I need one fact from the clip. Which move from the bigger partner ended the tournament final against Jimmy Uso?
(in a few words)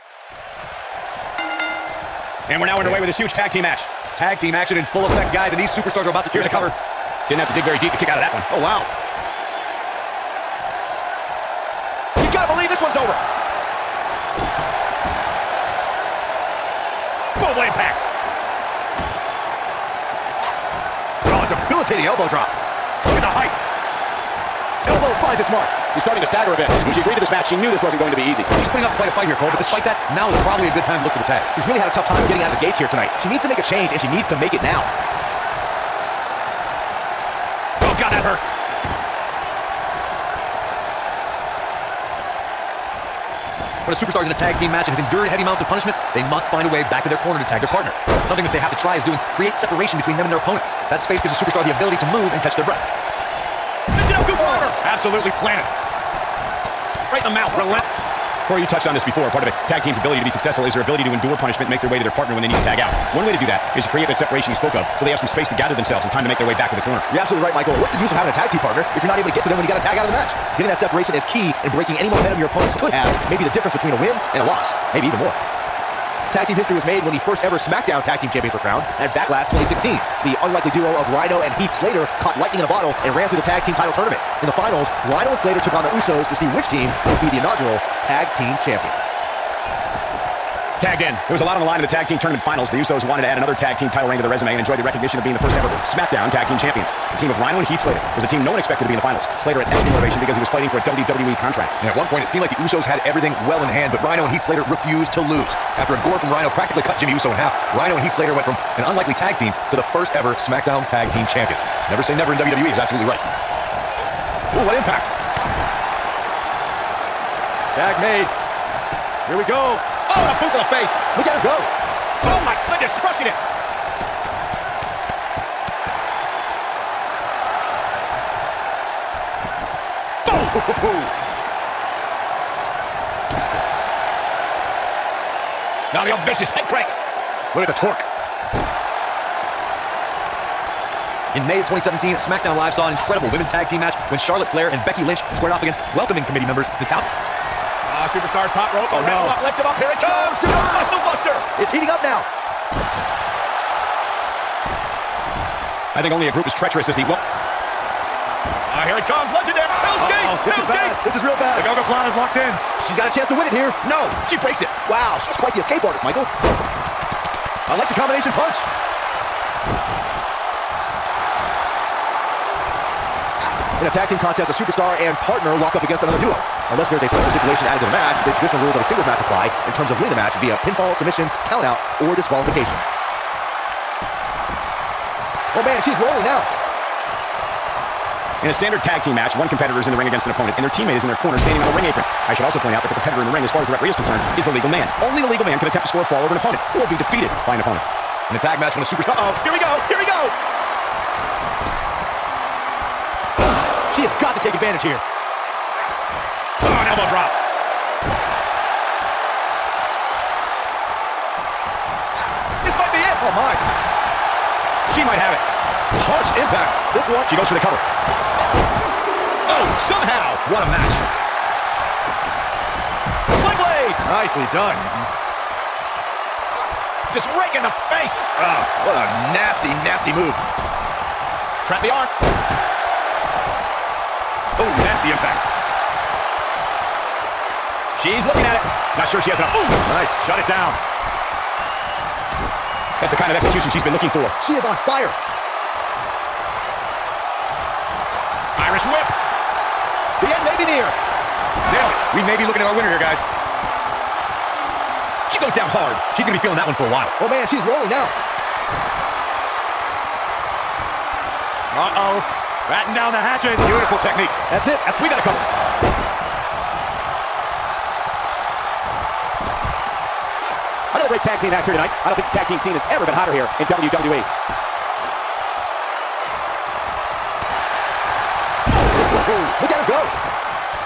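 A gore.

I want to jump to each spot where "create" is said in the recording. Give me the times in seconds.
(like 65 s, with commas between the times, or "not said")
49 s, 63 s.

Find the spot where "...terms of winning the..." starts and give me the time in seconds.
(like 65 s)
179 s.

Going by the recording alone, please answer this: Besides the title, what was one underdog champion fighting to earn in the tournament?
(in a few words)
A WWE contract.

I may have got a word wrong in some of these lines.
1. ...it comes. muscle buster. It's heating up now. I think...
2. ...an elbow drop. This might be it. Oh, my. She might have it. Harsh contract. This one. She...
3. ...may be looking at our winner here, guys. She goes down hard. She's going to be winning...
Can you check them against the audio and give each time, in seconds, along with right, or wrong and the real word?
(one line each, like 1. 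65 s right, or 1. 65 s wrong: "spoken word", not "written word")
1. 149 s right
2. 206 s wrong: "impact", not "contract"
3. 252 s wrong: "feeling", not "winning".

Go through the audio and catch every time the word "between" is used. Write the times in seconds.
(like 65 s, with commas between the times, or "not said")
49 s, 73 s.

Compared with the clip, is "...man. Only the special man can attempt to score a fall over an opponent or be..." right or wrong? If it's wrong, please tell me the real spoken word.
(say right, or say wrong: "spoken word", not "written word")
wrong: "legal", not "special".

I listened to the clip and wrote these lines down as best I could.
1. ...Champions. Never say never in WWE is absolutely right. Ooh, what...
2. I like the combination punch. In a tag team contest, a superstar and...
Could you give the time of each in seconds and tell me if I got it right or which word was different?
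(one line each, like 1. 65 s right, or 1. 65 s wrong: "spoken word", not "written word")
1. 111 s right
2. 166 s right.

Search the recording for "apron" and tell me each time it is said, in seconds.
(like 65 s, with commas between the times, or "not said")
191 s.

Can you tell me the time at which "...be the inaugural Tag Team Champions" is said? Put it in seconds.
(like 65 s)
87 s.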